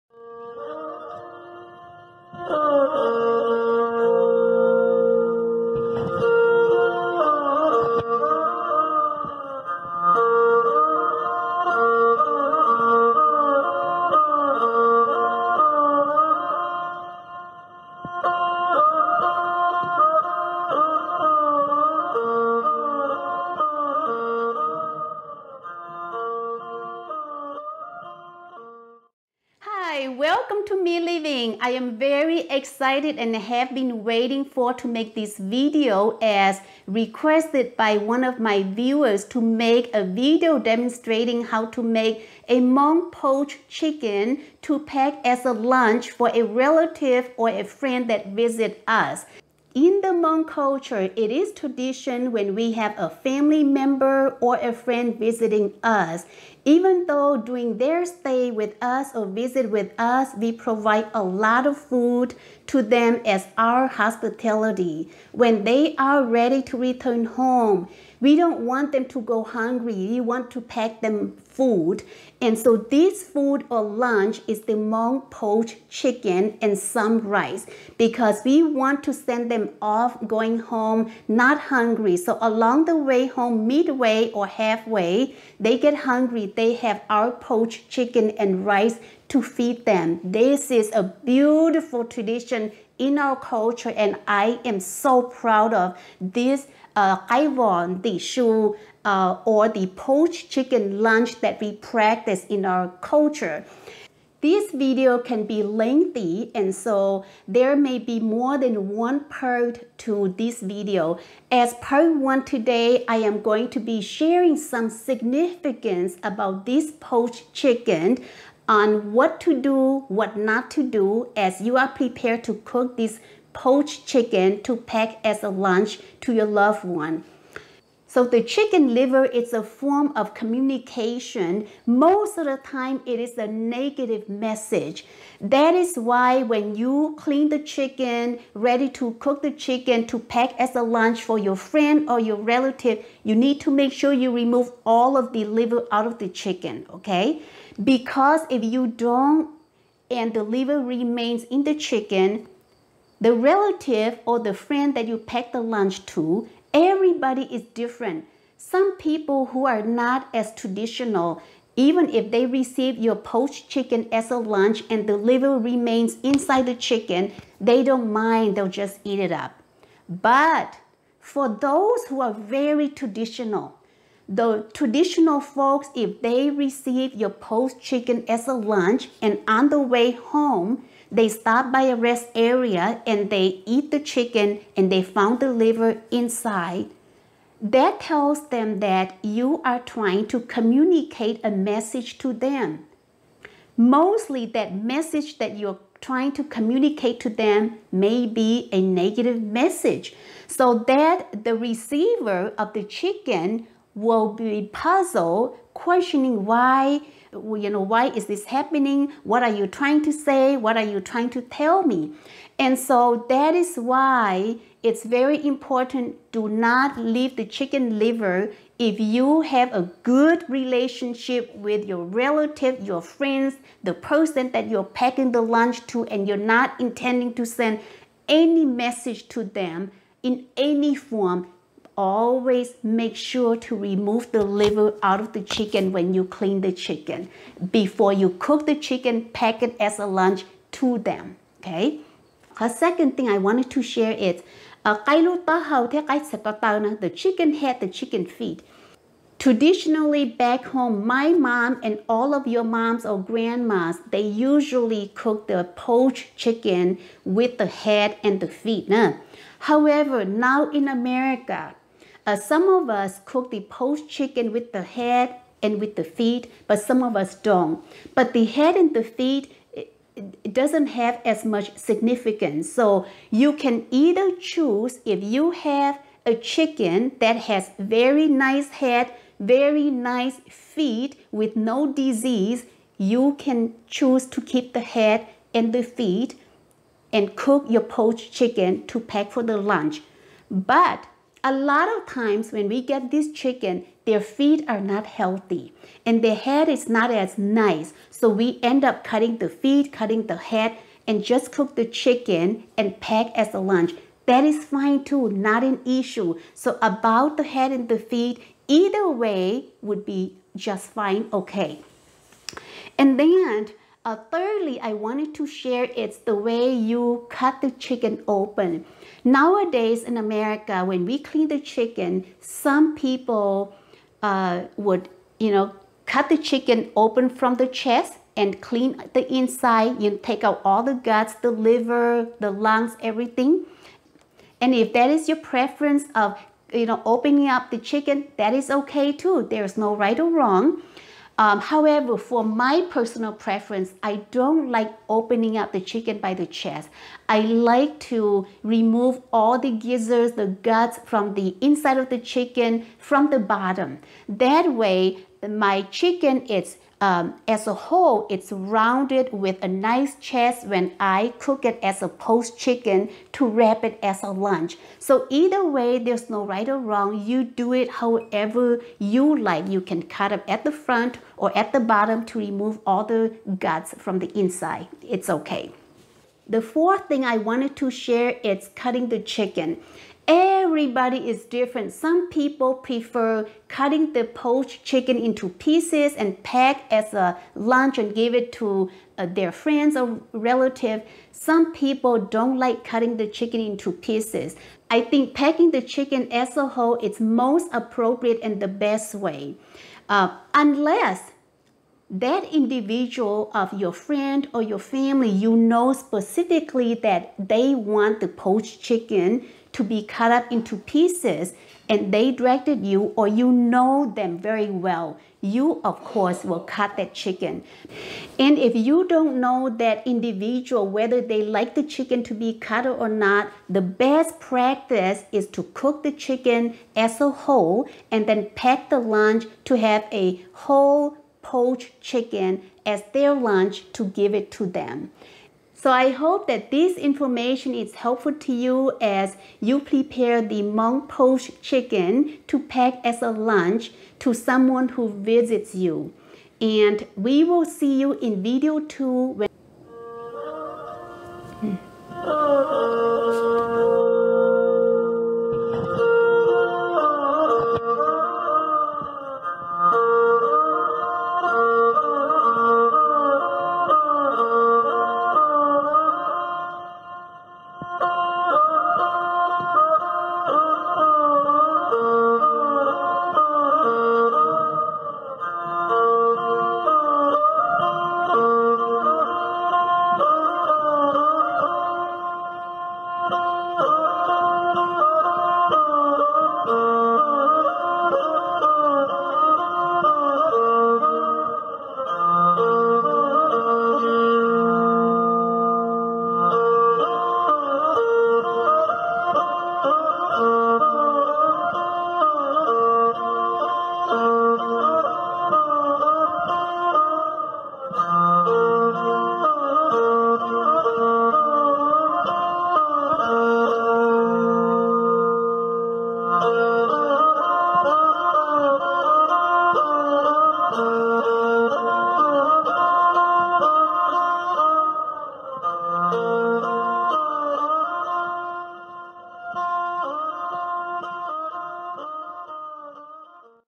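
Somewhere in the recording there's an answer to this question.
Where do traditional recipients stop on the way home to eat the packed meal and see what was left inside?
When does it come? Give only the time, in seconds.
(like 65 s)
181 s.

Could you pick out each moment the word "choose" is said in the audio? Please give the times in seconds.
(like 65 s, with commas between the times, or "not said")
274 s, 283 s.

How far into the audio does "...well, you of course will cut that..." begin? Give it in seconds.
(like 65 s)
414 s.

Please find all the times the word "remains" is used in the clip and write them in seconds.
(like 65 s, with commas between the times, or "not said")
150 s, 165 s.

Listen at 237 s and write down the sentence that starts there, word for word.
Before you cook the chicken, pack it as a lunch to them, okay?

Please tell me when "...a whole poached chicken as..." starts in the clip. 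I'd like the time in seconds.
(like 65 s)
430 s.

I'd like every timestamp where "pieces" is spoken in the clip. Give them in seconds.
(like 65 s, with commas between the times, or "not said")
385 s, 393 s, 410 s.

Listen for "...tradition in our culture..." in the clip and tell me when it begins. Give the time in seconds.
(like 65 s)
92 s.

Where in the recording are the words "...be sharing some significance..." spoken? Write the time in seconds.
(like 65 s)
113 s.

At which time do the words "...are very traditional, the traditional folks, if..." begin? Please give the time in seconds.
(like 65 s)
172 s.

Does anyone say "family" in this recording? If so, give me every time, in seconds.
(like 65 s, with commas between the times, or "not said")
53 s, 404 s.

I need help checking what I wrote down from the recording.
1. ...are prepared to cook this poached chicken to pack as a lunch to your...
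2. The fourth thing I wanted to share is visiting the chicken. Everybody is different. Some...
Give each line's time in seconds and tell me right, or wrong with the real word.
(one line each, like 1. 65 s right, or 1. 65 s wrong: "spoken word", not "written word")
1. 121 s right
2. 376 s wrong: "cutting", not "visiting".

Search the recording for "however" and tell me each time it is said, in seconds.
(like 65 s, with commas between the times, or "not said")
259 s, 341 s, 367 s.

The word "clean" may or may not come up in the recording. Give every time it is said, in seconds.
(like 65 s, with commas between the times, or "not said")
137 s, 236 s, 321 s, 328 s.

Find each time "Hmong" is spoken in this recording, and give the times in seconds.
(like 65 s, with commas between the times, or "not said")
42 s, 50 s, 74 s, 440 s.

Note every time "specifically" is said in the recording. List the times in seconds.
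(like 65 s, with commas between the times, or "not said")
405 s.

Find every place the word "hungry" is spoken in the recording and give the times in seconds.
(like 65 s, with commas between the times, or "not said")
69 s, 81 s, 85 s.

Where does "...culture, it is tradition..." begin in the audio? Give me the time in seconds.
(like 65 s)
50 s.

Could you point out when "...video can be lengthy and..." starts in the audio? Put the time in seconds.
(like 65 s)
104 s.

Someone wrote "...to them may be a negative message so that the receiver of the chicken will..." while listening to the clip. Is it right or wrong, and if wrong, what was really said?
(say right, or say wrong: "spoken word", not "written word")
right.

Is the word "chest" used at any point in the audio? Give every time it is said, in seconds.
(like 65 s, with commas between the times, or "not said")
327 s, 346 s, 360 s.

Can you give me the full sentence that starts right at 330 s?
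You take out all the guts, the liver, the lungs, everything.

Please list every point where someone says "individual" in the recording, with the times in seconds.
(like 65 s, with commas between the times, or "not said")
402 s, 420 s.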